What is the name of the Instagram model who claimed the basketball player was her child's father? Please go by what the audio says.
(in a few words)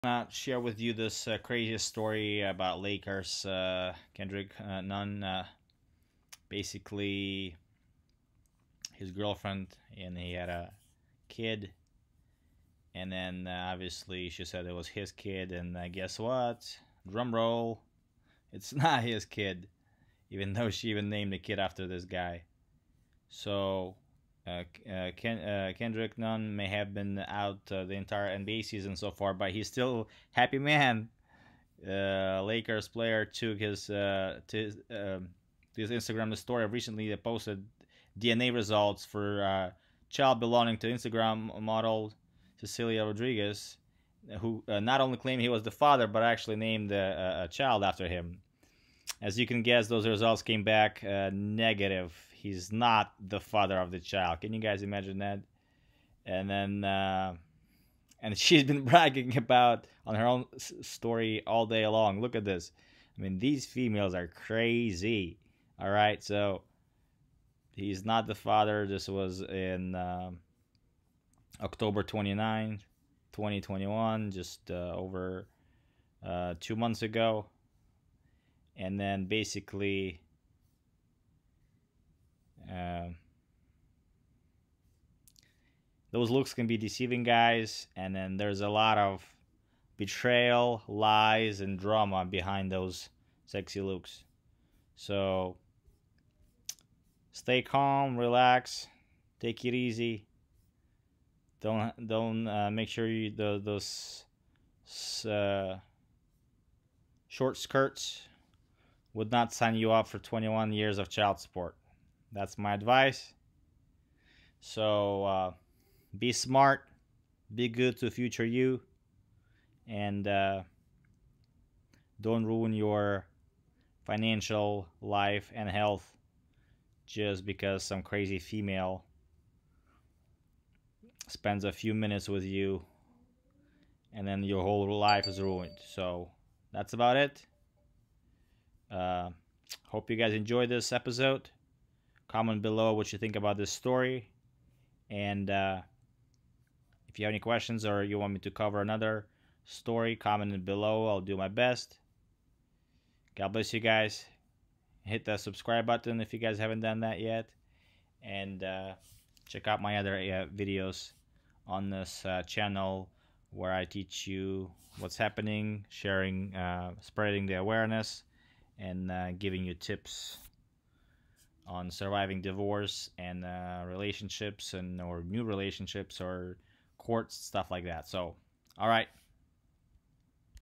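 Cecilia Rodriguez.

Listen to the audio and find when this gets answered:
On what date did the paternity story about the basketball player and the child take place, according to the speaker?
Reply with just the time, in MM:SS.
01:11.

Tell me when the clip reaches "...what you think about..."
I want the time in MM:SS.
02:22.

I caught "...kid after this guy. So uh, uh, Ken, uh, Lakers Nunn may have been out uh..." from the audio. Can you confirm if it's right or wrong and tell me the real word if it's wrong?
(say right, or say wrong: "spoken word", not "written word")
wrong: "Kendrick", not "Lakers".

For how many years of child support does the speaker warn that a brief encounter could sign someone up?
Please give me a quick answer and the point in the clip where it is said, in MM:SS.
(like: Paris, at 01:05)
21, at 01:50.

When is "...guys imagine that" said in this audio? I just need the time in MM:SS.
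00:54.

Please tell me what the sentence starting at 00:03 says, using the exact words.
Uh, Kendrick uh, Nunn, uh, basically, his girlfriend, and he had a kid.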